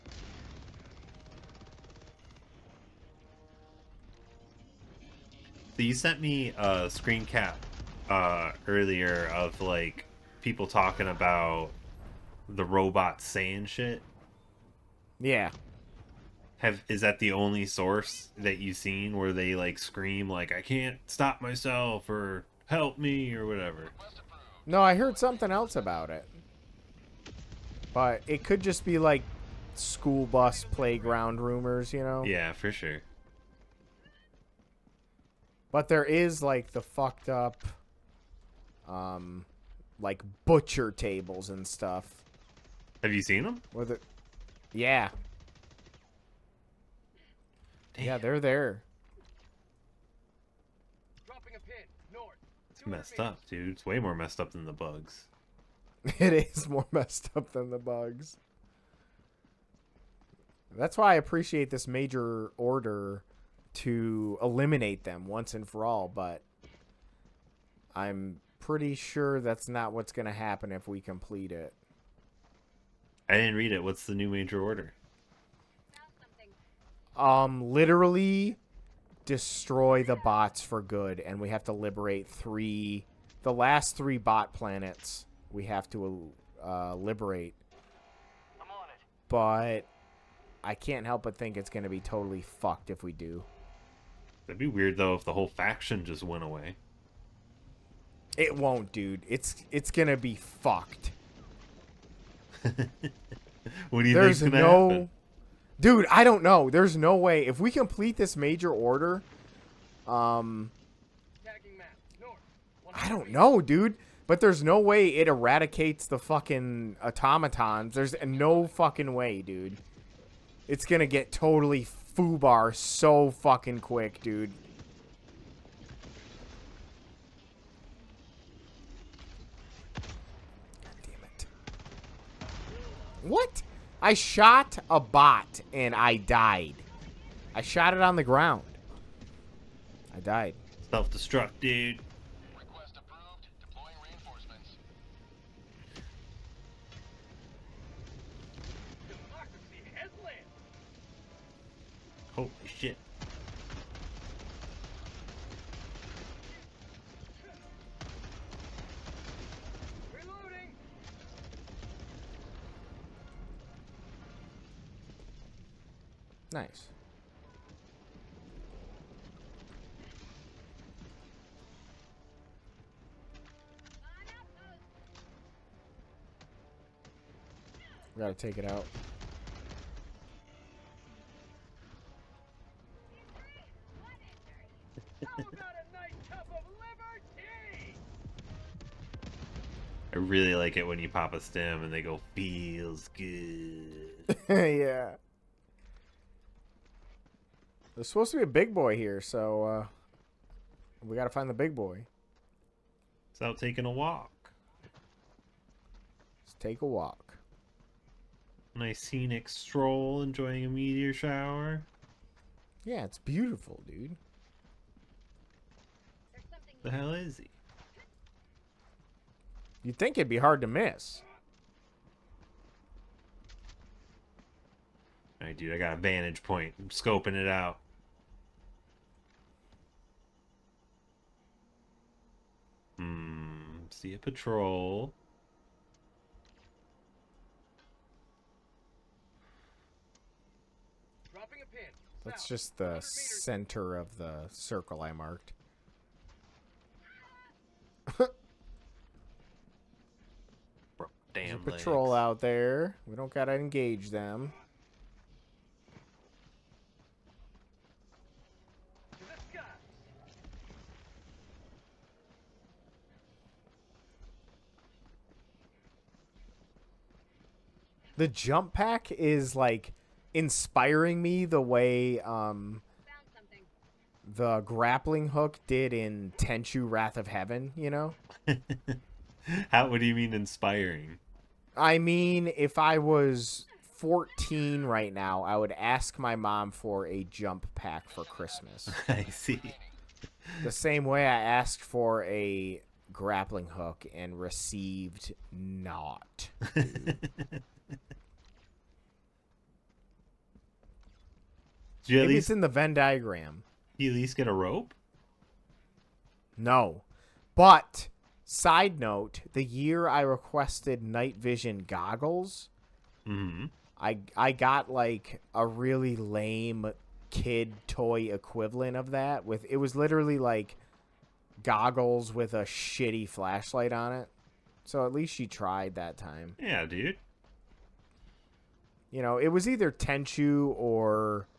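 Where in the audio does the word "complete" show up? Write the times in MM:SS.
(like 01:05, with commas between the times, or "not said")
01:11, 01:47.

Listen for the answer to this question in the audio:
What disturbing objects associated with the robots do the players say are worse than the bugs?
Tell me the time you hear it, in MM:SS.
00:40.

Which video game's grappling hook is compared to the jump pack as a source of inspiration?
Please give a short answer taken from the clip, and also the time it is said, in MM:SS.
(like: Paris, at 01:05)
Tenchu Wrath of Heaven, at 04:36.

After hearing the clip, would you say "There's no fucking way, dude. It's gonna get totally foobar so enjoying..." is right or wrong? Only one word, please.
wrong.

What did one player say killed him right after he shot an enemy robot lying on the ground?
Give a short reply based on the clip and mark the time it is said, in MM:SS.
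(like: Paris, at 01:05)
Self-destruct, at 02:20.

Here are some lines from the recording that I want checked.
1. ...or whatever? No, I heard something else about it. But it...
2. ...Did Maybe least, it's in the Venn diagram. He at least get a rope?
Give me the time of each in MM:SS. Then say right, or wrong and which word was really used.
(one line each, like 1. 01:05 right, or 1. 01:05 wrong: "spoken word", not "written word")
1. 00:23 right
2. 05:02 right.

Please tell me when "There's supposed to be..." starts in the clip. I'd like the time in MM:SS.
03:17.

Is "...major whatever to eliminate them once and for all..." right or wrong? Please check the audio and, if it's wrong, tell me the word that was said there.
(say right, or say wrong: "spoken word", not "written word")
wrong: "order", not "whatever".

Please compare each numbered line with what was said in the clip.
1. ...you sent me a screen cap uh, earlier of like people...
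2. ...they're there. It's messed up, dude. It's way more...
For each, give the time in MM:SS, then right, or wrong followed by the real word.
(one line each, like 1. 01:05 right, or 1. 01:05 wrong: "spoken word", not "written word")
1. 00:05 right
2. 00:48 right.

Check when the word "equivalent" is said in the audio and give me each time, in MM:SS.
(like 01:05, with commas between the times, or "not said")
05:18.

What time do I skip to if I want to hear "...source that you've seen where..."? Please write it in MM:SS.
00:17.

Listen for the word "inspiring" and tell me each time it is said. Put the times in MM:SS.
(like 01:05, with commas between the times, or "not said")
04:30, 04:40.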